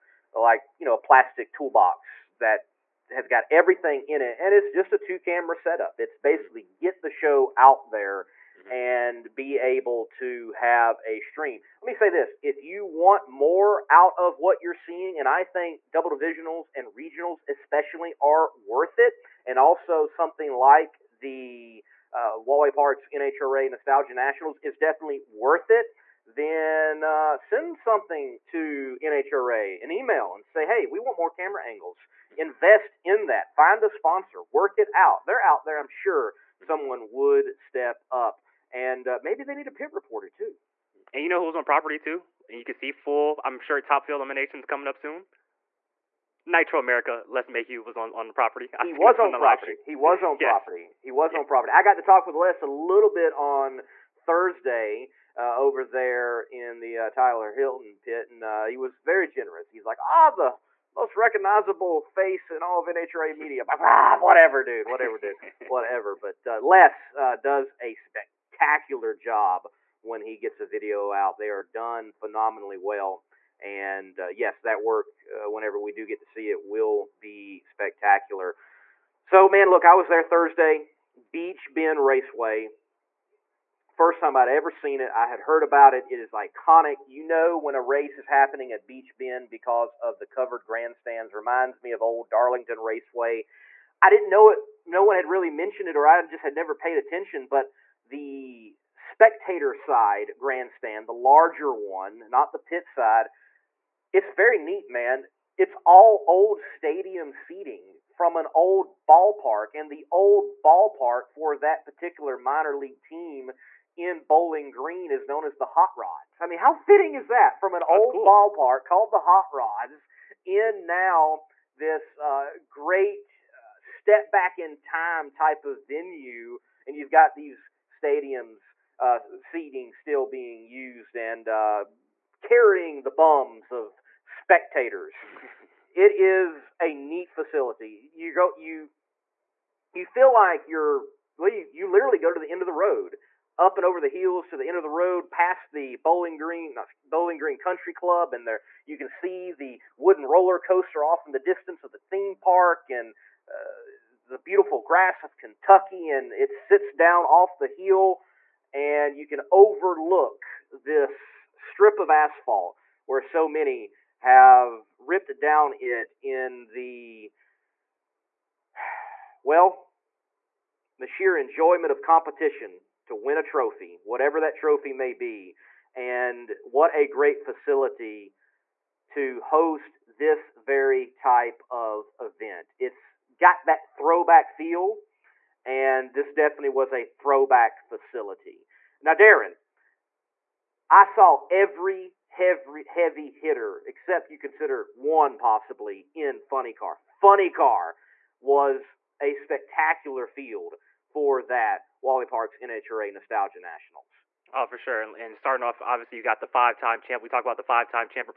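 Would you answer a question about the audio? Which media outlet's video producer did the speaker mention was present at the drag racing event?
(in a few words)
Nitro America.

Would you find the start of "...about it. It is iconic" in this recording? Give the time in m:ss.
1:25.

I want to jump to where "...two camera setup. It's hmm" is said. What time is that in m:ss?
0:04.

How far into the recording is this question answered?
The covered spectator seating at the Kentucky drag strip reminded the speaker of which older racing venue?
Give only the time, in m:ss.
1:32.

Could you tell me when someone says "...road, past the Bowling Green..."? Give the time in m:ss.
2:24.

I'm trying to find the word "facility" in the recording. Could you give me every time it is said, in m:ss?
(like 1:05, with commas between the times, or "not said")
2:17, 2:57, 3:07.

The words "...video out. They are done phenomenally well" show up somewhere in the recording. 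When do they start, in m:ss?
1:10.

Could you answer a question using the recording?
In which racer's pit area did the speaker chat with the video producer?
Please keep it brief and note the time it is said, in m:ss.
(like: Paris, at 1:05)
Tyler Hilton, at 0:57.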